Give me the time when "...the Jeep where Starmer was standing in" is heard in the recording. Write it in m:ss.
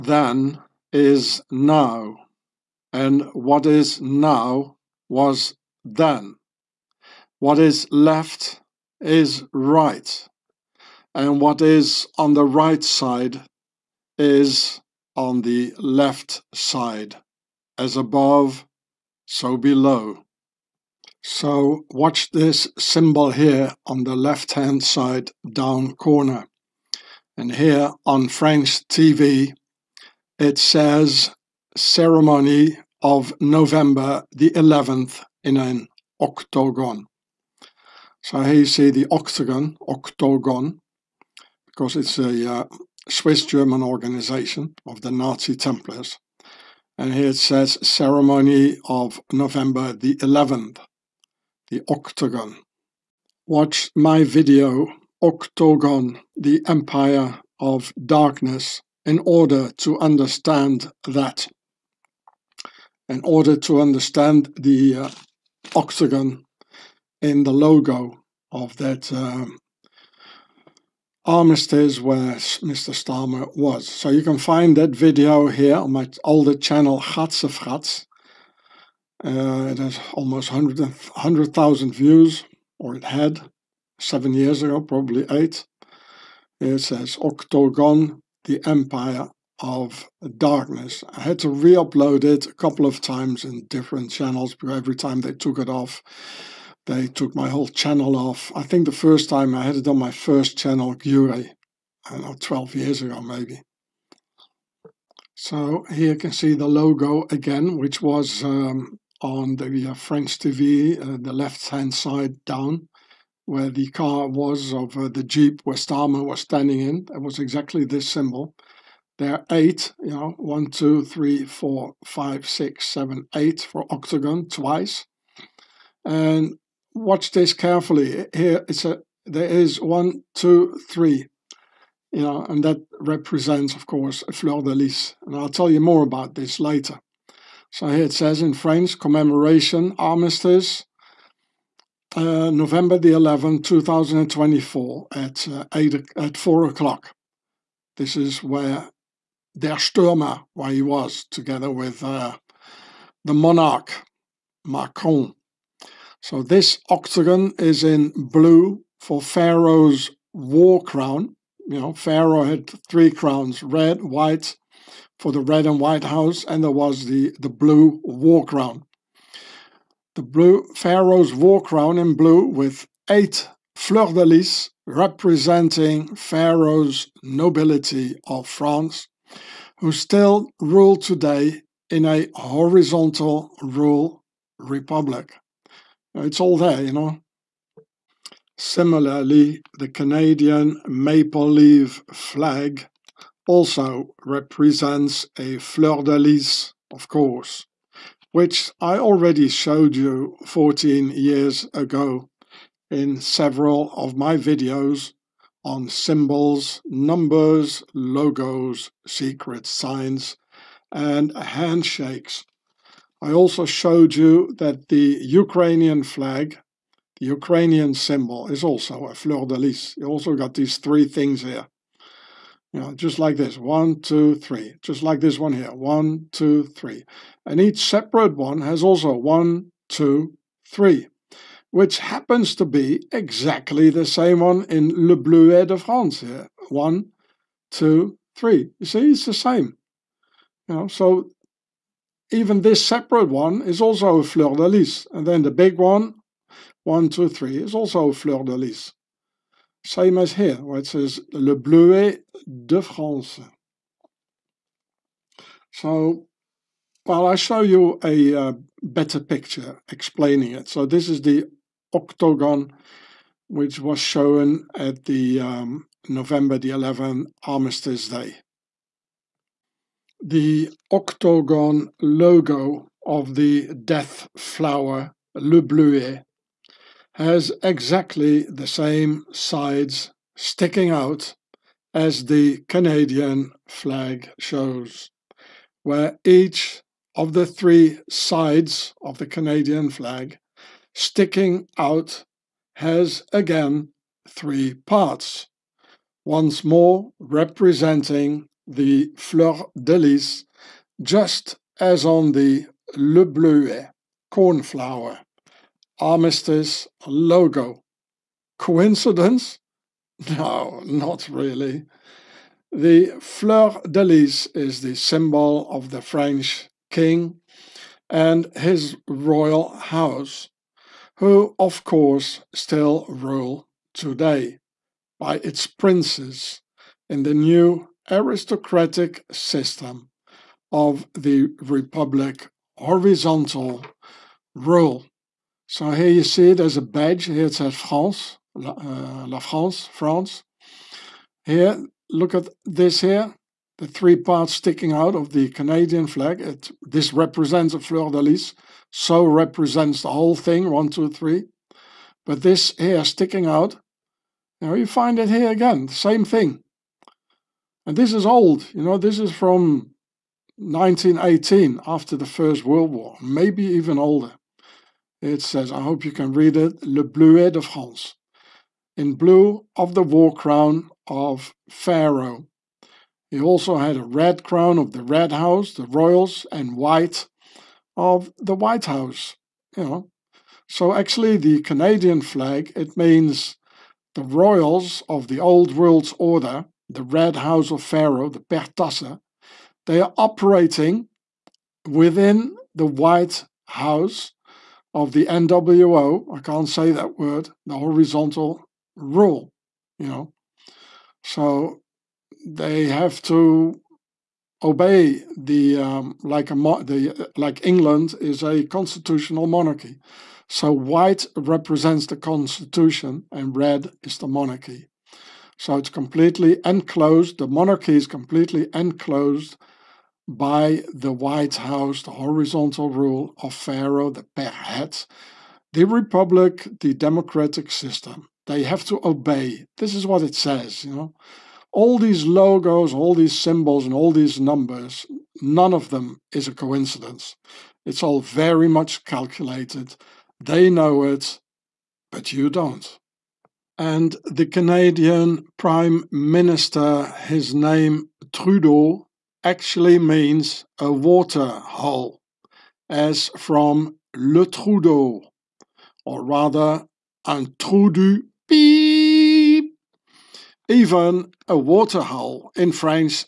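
1:55.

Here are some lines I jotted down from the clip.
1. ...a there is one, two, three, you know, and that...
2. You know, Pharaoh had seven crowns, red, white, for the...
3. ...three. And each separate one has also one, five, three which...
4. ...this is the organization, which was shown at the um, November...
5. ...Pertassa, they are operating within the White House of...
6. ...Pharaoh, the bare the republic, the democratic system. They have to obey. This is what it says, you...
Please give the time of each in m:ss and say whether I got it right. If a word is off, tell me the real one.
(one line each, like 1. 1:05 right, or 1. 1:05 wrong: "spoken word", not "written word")
1. 2:08 right
2. 2:41 wrong: "three", not "seven"
3. 3:46 wrong: "two", not "five"
4. 4:20 wrong: "octagon", not "organization"
5. 6:28 right
6. 7:03 right.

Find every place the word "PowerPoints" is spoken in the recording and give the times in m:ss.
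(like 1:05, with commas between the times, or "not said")
not said.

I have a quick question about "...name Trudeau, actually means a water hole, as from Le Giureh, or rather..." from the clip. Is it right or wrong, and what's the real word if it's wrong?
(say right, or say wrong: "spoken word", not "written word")
wrong: "Trudeau", not "Giureh".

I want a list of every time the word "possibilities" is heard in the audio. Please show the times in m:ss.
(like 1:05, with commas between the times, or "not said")
not said.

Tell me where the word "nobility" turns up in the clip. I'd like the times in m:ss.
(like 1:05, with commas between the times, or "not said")
2:57.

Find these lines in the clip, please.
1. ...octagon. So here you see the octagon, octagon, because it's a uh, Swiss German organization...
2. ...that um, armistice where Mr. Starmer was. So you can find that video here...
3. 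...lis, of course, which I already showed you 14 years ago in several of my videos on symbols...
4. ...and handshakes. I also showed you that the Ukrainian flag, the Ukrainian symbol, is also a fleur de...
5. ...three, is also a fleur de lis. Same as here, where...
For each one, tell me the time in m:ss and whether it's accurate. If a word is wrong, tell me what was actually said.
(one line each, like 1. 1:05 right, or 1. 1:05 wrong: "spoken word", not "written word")
1. 0:36 right
2. 1:08 right
3. 3:16 right
4. 3:30 right
5. 4:07 right.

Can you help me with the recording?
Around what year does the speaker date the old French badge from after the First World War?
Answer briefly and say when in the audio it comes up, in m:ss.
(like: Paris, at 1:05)
1918, at 6:00.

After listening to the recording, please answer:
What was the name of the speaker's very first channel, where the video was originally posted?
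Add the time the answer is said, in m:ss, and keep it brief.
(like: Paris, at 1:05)
Giureh, at 1:40.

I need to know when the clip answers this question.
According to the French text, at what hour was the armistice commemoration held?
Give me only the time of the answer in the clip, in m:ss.
2:26.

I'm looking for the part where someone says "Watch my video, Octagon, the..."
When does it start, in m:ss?
0:53.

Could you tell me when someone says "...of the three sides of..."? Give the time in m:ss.
4:47.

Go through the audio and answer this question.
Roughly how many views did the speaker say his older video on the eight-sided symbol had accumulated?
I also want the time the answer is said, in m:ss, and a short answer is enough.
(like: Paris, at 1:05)
almost 100,000, at 1:20.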